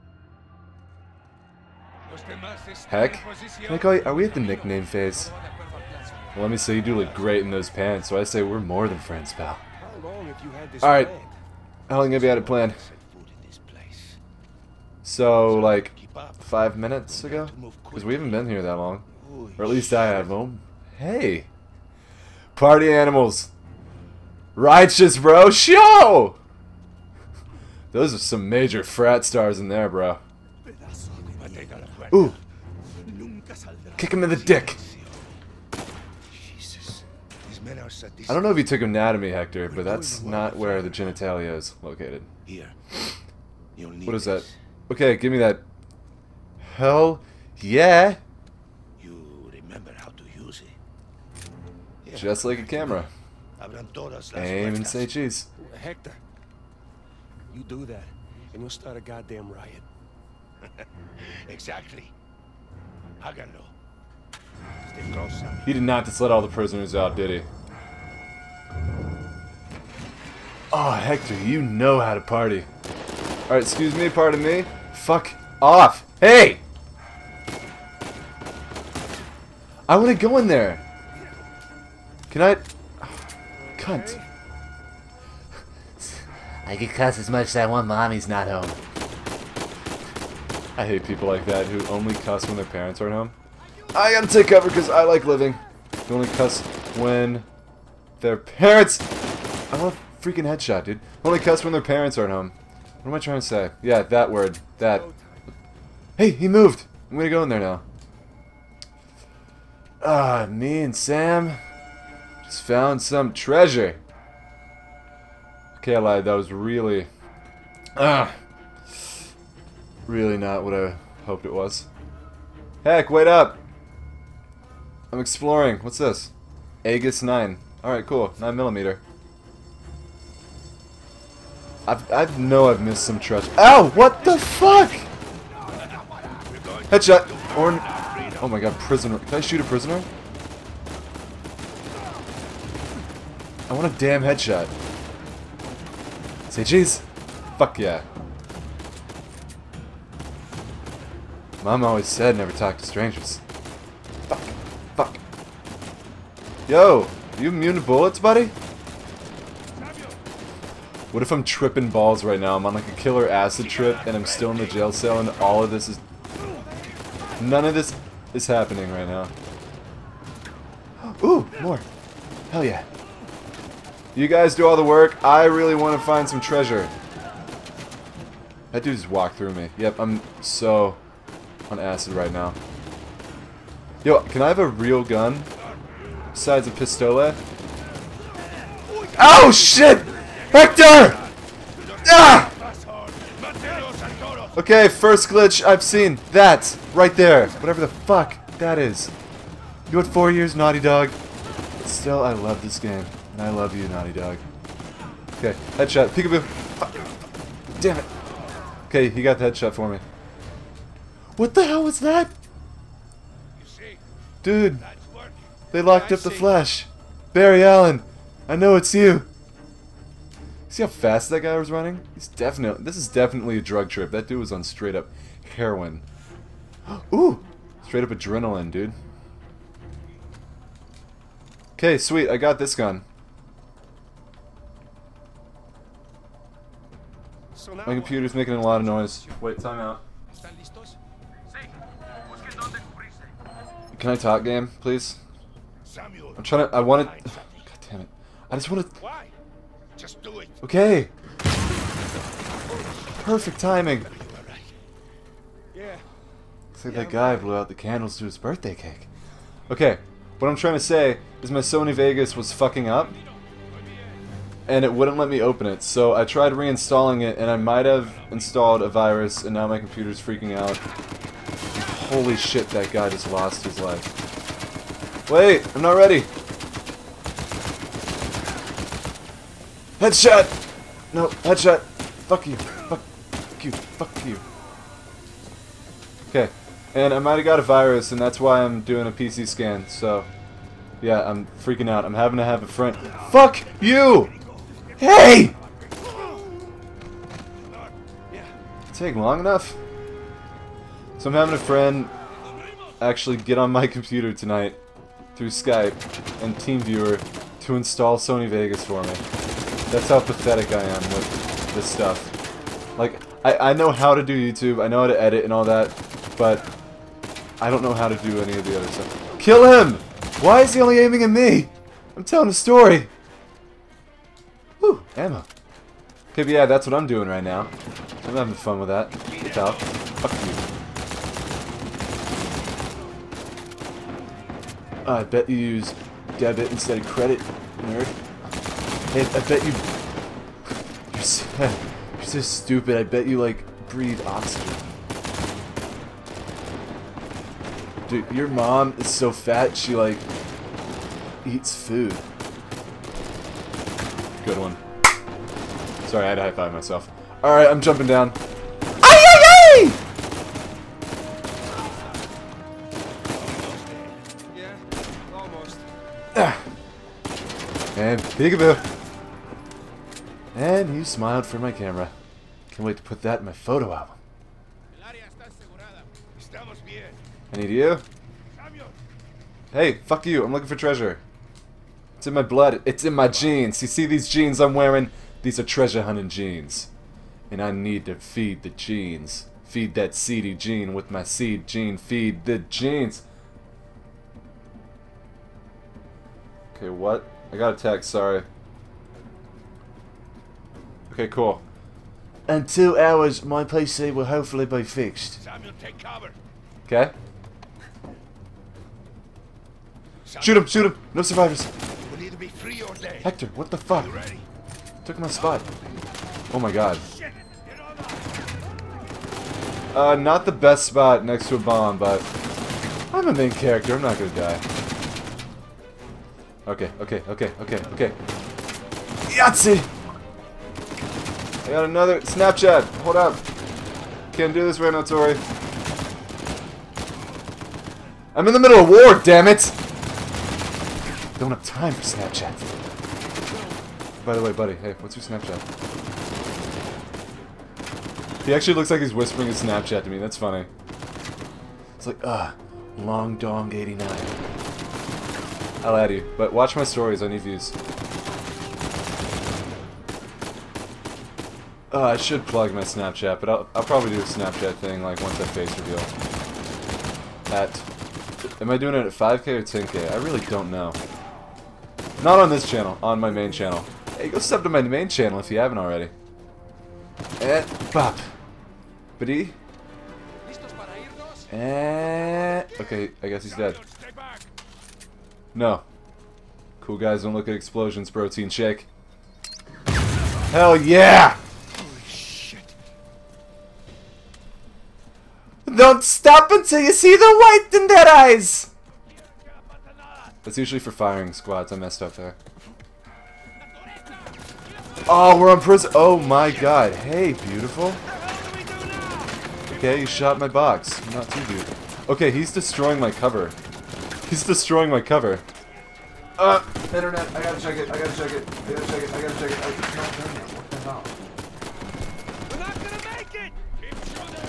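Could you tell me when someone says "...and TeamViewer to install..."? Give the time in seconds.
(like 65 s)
306 s.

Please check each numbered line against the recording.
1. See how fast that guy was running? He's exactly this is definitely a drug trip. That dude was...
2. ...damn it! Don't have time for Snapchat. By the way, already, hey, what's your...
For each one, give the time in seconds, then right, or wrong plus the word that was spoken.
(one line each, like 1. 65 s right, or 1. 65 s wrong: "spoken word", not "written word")
1. 220 s wrong: "definitely", not "exactly"
2. 439 s wrong: "buddy", not "already".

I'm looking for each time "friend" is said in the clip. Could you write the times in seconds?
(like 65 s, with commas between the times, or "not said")
8 s, 292 s, 301 s.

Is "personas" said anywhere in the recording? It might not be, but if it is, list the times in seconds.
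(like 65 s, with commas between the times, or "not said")
not said.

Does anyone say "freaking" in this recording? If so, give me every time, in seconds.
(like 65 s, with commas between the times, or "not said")
100 s, 270 s, 291 s.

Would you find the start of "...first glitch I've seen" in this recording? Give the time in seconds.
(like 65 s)
194 s.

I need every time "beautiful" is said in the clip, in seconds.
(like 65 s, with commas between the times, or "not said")
507 s, 511 s.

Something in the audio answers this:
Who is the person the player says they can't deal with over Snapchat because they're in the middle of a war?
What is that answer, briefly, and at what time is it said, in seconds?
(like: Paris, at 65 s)
Tori, at 435 s.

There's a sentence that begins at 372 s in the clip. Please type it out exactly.
Can't wait to put that in my photo album.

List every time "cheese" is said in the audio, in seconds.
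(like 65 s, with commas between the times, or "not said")
55 s, 146 s.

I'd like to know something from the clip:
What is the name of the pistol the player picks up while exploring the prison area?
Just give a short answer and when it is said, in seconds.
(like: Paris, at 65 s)
Aegis 9, at 126 s.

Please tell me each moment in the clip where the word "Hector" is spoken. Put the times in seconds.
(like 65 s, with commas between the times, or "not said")
39 s, 55 s, 70 s, 190 s, 413 s.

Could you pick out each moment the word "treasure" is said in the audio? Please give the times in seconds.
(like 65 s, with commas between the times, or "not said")
113 s, 176 s, 380 s, 385 s.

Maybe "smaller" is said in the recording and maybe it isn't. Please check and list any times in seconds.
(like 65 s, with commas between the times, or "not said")
not said.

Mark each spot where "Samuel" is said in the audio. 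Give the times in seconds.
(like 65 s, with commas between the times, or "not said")
245 s, 405 s.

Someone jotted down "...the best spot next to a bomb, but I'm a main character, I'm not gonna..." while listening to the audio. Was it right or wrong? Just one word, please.
right.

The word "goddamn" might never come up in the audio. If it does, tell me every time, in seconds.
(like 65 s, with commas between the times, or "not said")
58 s.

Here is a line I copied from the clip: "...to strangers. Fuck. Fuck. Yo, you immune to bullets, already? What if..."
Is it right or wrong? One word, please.
wrong.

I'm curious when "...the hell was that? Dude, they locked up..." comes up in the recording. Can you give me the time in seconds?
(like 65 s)
211 s.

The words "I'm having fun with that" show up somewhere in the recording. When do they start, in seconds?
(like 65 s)
328 s.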